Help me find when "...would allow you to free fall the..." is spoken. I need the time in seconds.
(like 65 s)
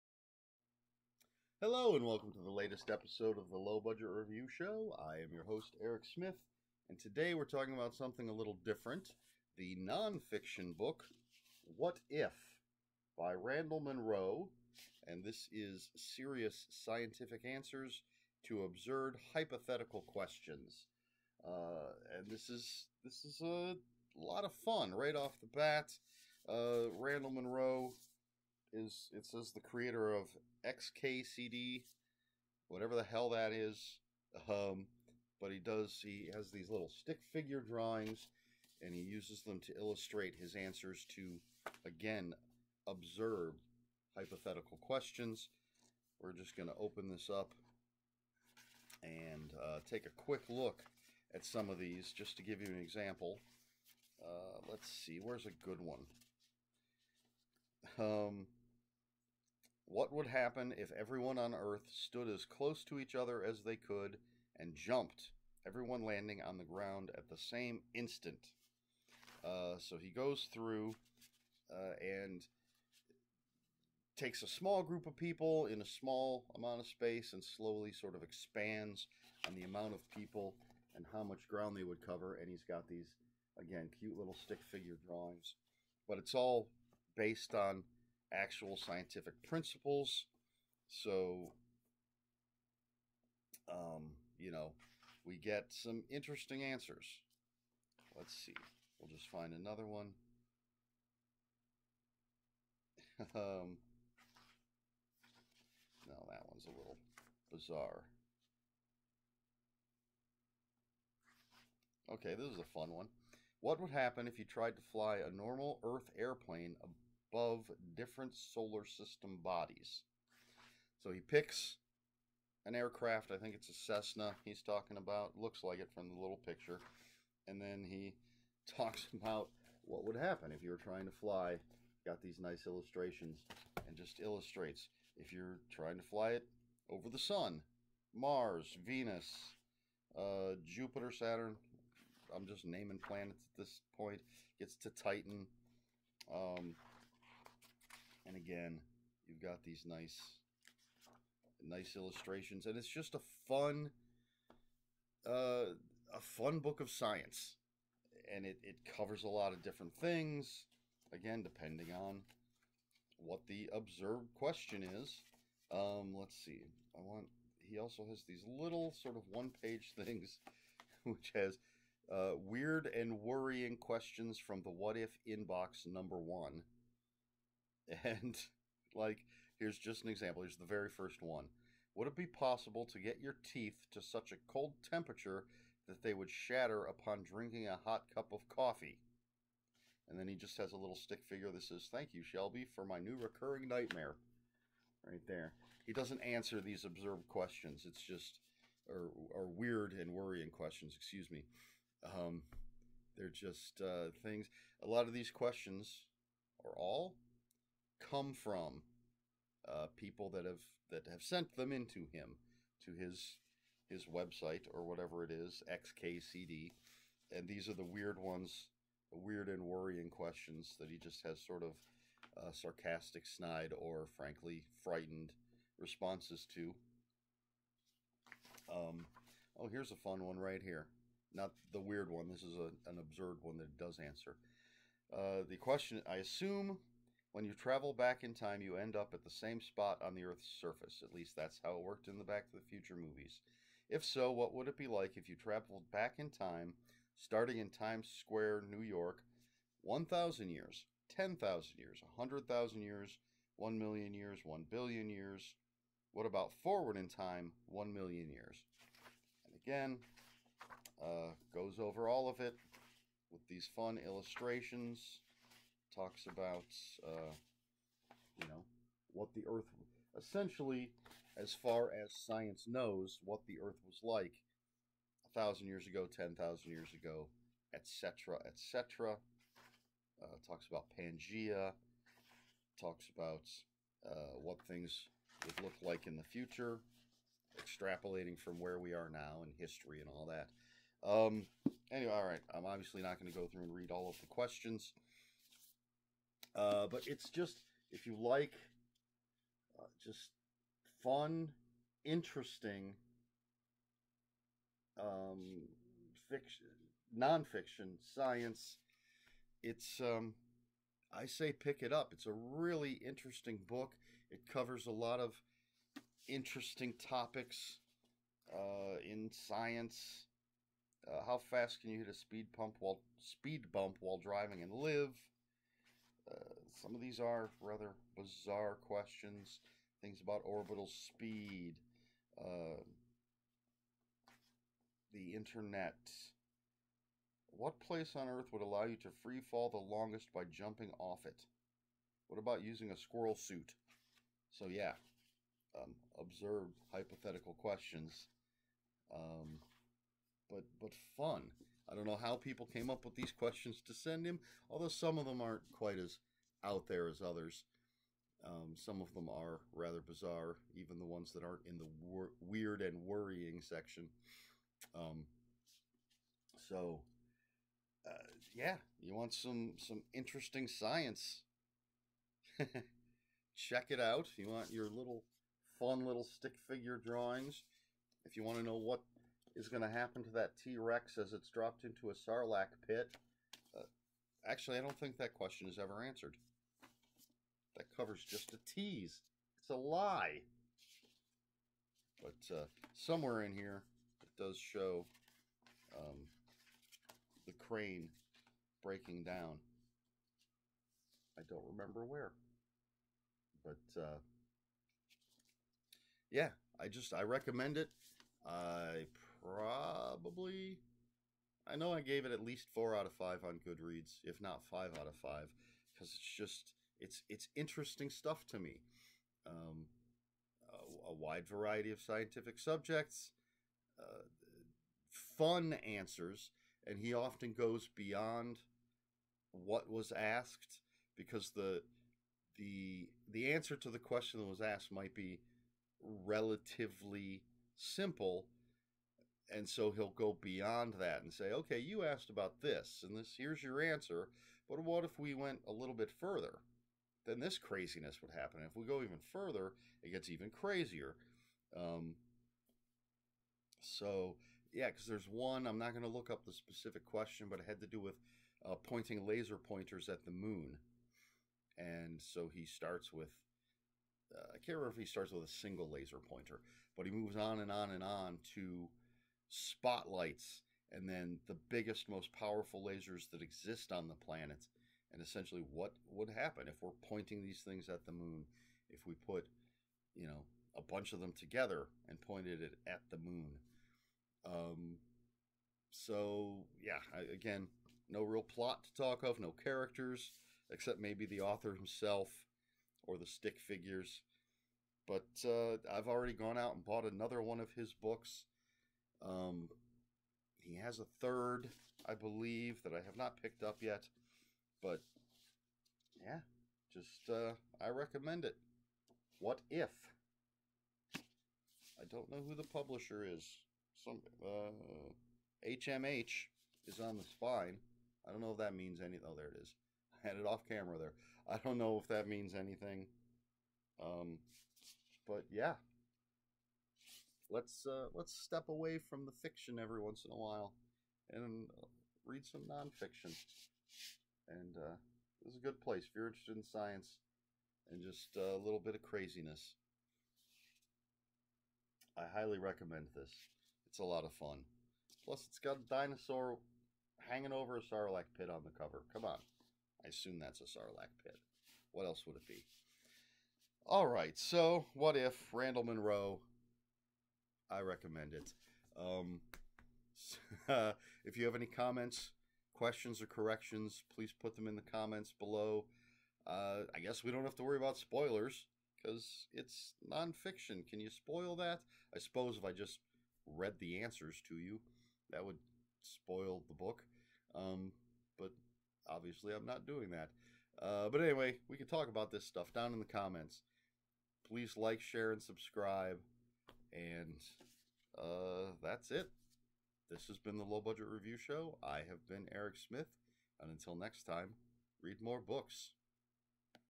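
338 s.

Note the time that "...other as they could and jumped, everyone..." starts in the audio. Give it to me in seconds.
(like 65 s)
63 s.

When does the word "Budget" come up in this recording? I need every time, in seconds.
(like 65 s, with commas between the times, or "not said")
3 s, 590 s.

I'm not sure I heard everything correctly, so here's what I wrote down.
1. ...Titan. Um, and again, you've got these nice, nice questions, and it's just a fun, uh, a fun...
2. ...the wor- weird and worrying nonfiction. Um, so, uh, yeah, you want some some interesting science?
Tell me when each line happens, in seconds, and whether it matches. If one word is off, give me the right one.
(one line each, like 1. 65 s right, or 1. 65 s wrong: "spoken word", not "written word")
1. 144 s wrong: "illustrations", not "questions"
2. 361 s wrong: "section", not "nonfiction".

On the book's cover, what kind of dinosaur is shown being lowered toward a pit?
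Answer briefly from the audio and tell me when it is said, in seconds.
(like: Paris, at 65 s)
T-Rex, at 380 s.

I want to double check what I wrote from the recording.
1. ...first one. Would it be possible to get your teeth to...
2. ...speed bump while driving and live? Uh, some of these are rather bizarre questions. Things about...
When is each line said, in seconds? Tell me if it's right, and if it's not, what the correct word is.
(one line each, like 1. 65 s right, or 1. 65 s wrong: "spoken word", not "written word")
1. 180 s right
2. 323 s right.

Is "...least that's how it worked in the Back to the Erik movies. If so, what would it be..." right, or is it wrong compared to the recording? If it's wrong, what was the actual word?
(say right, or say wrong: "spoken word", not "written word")
wrong: "Future", not "Erik".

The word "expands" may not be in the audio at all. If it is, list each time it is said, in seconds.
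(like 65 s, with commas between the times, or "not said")
78 s.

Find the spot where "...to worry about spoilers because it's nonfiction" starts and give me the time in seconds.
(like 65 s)
567 s.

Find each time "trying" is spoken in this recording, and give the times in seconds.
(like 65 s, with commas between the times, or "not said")
130 s, 135 s.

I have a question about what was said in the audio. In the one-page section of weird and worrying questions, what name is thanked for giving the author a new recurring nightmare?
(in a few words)
Shelby.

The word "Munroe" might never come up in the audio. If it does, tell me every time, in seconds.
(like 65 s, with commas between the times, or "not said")
13 s, 27 s, 555 s.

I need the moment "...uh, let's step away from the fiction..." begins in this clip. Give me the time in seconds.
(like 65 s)
527 s.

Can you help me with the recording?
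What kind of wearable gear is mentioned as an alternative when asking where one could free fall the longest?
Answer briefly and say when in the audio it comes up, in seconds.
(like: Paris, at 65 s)
squirrel suit, at 342 s.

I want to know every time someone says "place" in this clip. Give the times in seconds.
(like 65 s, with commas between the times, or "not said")
337 s, 535 s.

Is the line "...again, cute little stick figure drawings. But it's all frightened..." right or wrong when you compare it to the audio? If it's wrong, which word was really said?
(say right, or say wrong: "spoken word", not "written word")
wrong: "based", not "frightened".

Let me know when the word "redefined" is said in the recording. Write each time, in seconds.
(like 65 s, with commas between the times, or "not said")
not said.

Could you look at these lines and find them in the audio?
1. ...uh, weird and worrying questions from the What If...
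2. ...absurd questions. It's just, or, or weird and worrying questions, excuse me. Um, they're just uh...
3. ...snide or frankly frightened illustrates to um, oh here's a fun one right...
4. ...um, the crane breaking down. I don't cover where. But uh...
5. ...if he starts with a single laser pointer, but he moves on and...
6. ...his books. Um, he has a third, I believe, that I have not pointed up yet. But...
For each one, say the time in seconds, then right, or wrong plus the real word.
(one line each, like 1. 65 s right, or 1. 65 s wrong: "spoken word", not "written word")
1. 172 s right
2. 196 s right
3. 223 s wrong: "responses", not "illustrates"
4. 395 s wrong: "remember", not "cover"
5. 464 s right
6. 497 s wrong: "picked", not "pointed".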